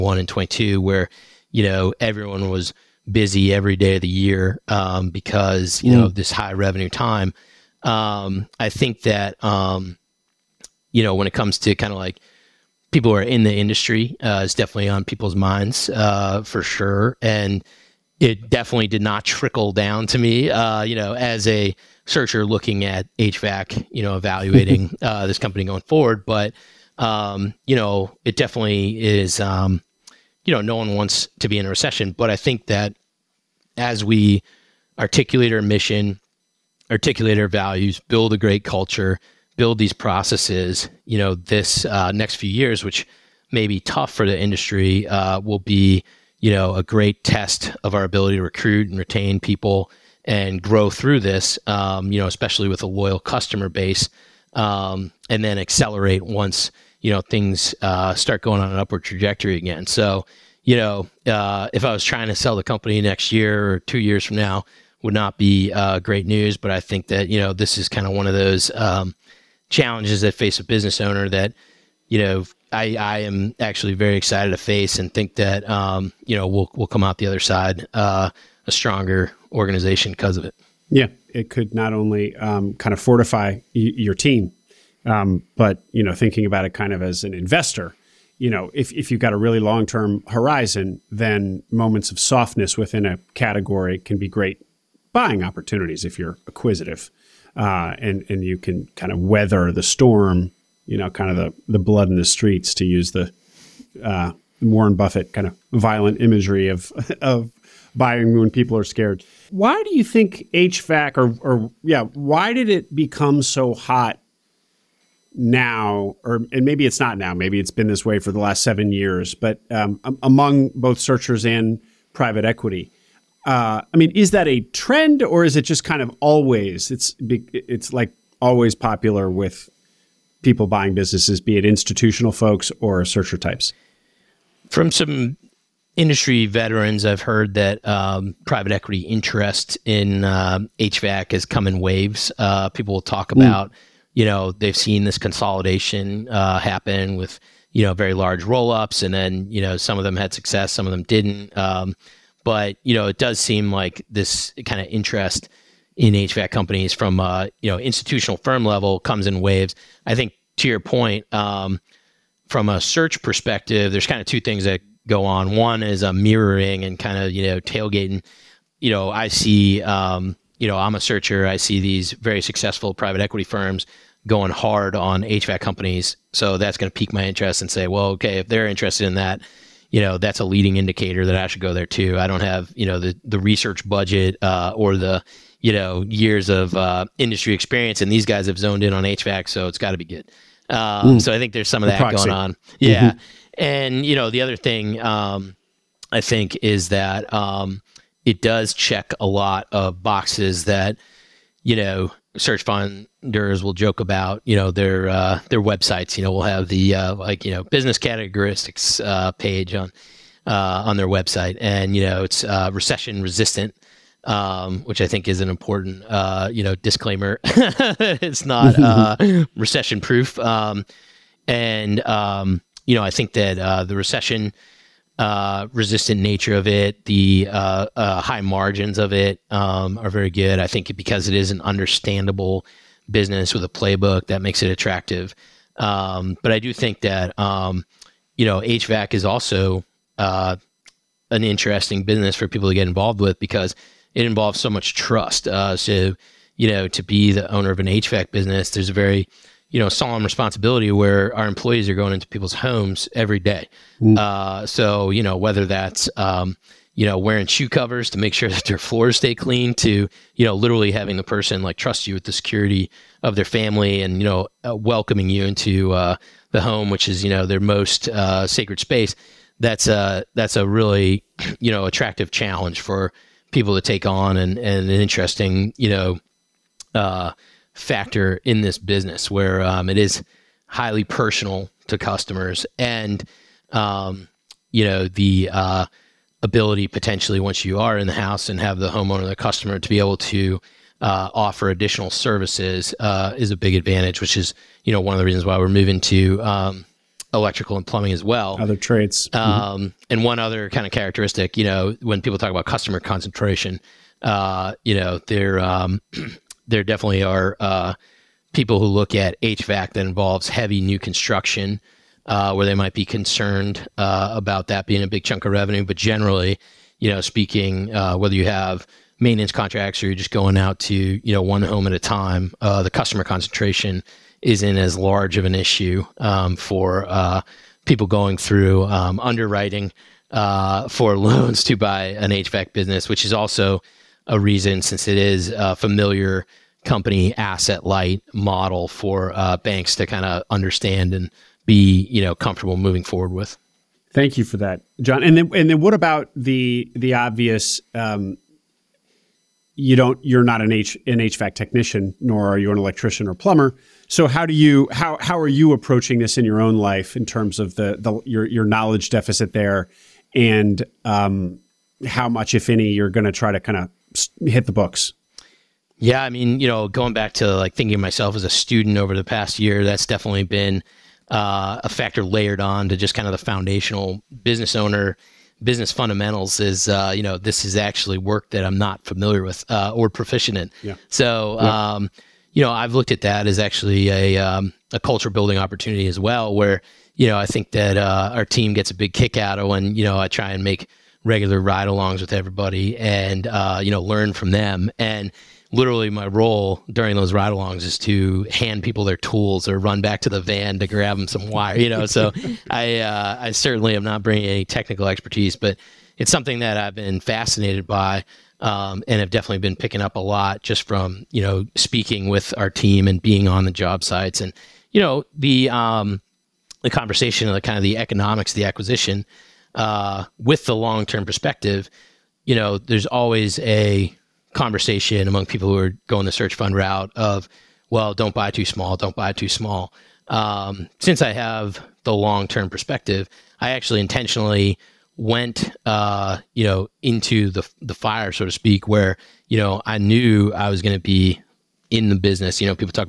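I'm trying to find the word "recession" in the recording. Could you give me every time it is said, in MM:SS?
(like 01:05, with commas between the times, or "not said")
00:31, 03:32, 03:39, 03:43.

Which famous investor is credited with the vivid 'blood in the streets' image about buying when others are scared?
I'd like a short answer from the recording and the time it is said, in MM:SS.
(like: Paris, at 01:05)
Warren Buffett, at 01:44.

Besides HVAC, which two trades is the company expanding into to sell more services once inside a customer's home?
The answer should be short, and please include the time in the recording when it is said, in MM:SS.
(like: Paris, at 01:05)
Electrical and plumbing, at 04:57.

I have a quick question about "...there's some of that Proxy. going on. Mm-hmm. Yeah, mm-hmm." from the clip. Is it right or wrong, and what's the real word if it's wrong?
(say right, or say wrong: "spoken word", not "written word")
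right.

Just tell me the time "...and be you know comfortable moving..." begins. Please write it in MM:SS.
05:41.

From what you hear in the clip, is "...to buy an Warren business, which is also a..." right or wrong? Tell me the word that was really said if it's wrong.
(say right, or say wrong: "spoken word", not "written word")
wrong: "HVAC", not "Warren".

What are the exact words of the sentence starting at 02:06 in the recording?
It's it's like always popular with people buying businesses, be it institutional folks or searcher types.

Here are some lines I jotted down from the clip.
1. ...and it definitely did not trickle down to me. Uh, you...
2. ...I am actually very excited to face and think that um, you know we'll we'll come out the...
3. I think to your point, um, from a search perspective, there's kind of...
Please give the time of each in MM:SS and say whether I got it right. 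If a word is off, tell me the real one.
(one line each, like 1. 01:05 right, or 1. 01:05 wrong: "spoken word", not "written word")
1. 00:17 right
2. 01:12 right
3. 02:40 right.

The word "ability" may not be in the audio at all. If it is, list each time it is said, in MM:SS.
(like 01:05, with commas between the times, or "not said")
00:48, 04:46.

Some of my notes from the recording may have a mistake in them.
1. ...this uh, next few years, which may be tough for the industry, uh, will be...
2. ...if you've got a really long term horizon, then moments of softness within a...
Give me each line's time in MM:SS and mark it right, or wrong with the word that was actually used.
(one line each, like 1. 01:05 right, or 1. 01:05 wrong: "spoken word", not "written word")
1. 00:41 right
2. 01:28 right.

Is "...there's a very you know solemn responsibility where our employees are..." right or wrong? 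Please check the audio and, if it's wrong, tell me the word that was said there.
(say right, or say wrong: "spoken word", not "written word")
right.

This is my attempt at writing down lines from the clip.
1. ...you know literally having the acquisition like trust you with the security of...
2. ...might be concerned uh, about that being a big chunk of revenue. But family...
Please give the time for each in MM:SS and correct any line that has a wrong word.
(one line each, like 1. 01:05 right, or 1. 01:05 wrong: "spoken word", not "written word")
1. 04:20 wrong: "person", not "acquisition"
2. 05:12 wrong: "generally", not "family".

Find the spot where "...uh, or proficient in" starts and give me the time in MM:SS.
06:19.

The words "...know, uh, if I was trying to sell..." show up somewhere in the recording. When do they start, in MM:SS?
01:00.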